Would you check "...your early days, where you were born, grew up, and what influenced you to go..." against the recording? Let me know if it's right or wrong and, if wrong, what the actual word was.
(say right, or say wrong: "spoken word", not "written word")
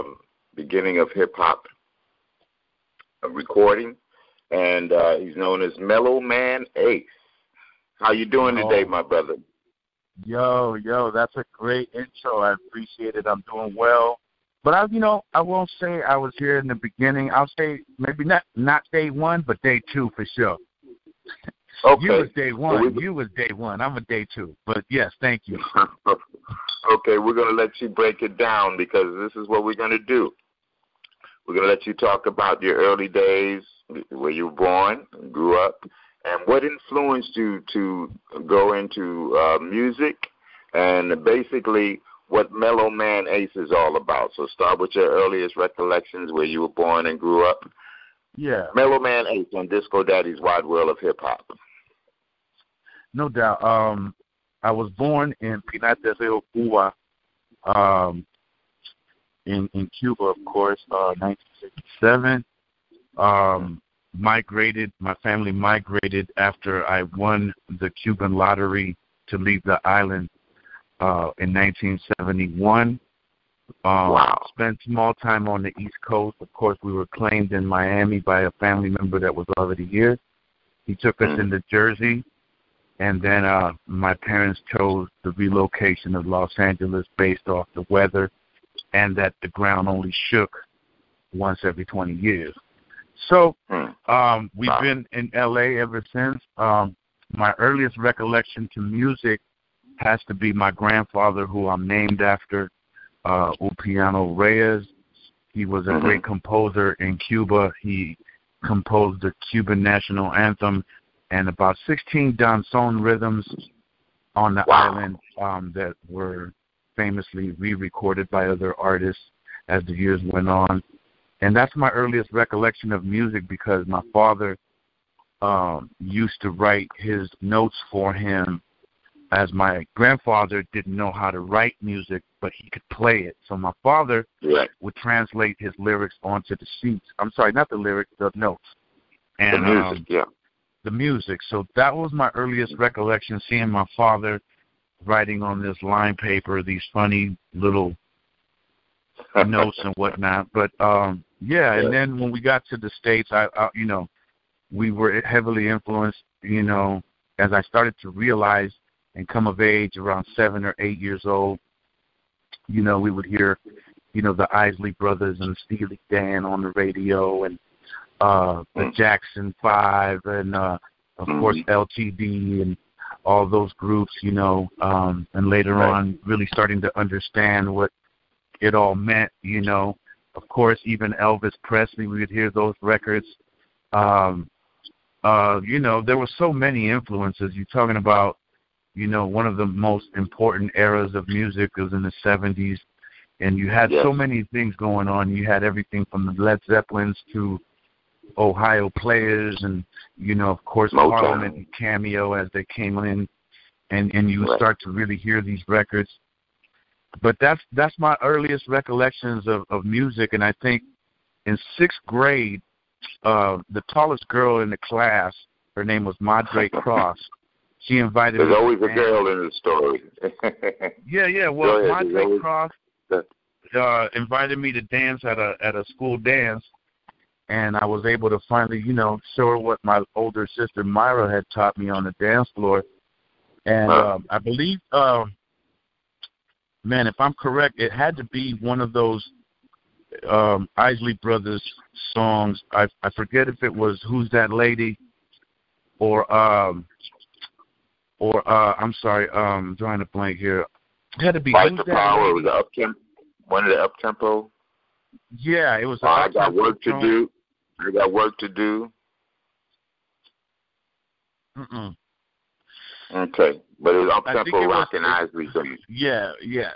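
right.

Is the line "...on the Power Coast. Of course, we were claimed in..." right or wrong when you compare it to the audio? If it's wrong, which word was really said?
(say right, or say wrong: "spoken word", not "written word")
wrong: "East", not "Power".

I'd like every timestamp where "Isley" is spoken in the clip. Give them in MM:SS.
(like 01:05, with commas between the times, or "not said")
02:44, 04:00.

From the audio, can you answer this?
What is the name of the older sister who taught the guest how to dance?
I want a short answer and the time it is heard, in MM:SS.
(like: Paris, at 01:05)
Myra, at 03:50.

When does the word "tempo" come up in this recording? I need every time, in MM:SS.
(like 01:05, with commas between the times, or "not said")
04:13, 04:24.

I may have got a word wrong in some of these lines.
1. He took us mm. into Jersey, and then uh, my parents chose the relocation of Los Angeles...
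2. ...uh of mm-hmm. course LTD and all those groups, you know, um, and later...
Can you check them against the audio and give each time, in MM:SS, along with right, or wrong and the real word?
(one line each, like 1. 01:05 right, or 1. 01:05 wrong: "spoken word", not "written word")
1. 01:20 right
2. 02:50 right.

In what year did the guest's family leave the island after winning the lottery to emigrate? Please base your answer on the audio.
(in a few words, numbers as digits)
1971.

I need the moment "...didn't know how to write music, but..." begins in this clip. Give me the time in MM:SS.
02:10.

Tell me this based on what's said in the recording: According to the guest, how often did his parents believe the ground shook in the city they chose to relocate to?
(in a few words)
Once every 20 years.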